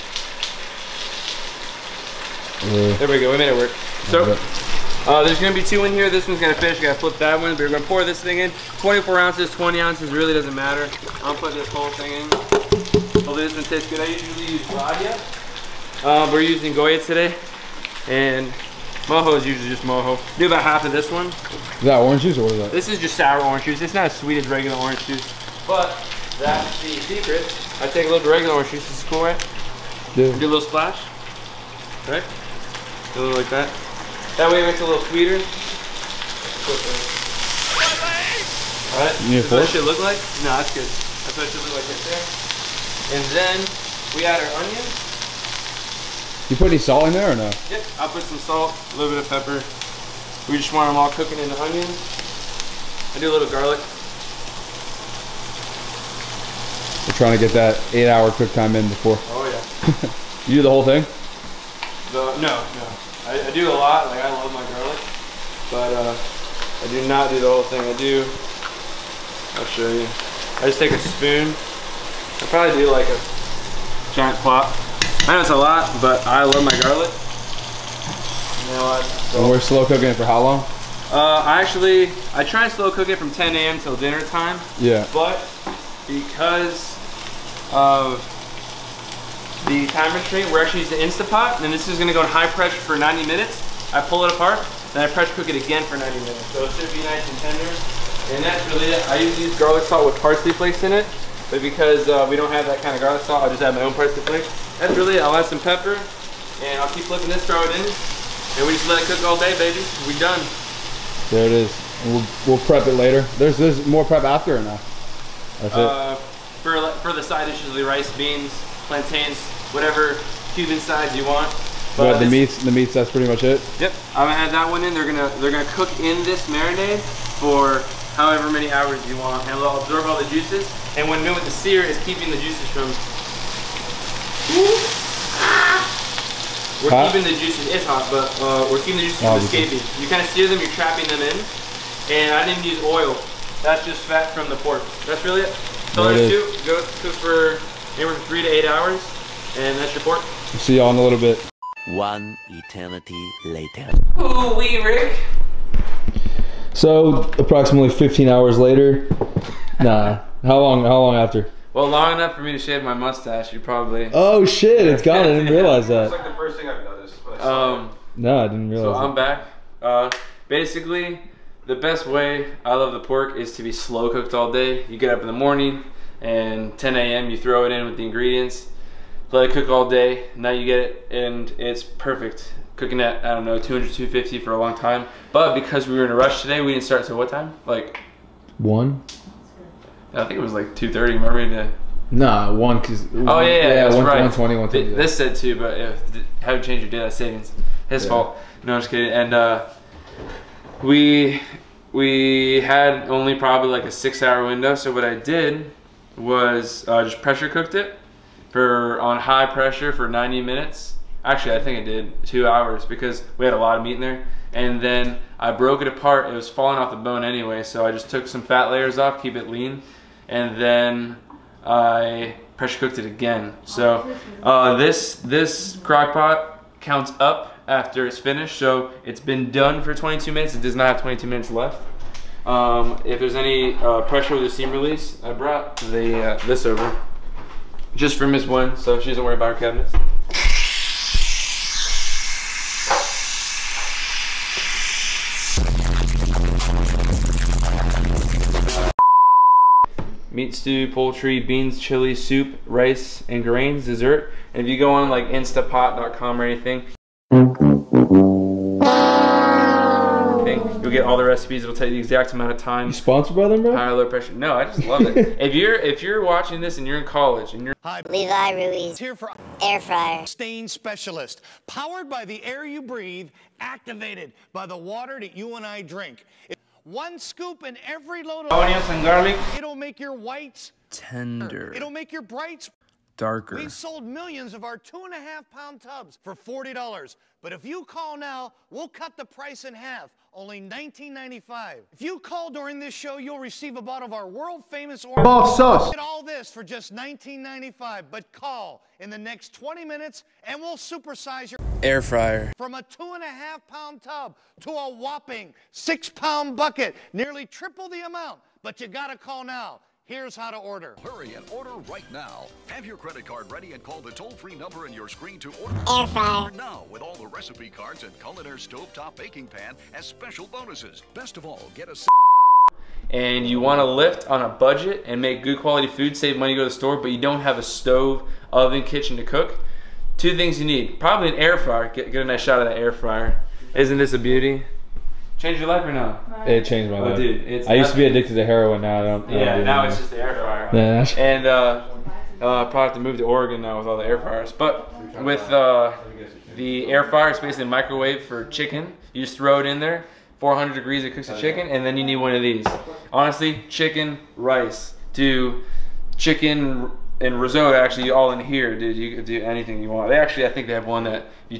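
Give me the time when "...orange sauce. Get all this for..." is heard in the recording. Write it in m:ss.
4:55.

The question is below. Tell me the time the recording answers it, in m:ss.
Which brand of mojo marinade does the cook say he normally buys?
0:14.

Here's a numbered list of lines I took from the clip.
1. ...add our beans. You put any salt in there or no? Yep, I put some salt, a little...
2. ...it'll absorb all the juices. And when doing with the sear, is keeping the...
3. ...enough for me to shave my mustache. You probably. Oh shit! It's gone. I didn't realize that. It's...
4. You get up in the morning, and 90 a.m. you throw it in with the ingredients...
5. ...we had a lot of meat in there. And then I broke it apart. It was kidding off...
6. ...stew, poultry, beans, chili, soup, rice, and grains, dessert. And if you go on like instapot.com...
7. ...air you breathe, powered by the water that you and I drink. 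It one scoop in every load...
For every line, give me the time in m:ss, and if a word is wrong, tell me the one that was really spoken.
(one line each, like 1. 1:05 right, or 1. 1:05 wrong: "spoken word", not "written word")
1. 0:44 wrong: "onions", not "beans"
2. 2:09 right
3. 2:42 right
4. 2:54 wrong: "10", not "90"
5. 3:33 wrong: "falling", not "kidding"
6. 4:10 right
7. 4:32 wrong: "activated", not "powered".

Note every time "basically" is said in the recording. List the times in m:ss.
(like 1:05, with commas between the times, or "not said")
2:50, 5:47.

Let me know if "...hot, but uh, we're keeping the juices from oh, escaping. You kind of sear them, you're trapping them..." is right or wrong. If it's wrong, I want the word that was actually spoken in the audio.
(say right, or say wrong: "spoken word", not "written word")
right.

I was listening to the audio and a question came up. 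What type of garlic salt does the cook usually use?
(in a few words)
garlic salt with parsley flakes.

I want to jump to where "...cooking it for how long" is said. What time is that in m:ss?
1:19.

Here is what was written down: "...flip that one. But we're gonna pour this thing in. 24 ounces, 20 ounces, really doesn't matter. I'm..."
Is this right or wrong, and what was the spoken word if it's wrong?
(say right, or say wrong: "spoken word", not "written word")
right.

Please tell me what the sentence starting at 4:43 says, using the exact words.
We've sold millions of our two and a half pound tubs for $40.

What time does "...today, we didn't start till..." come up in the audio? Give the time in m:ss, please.
3:06.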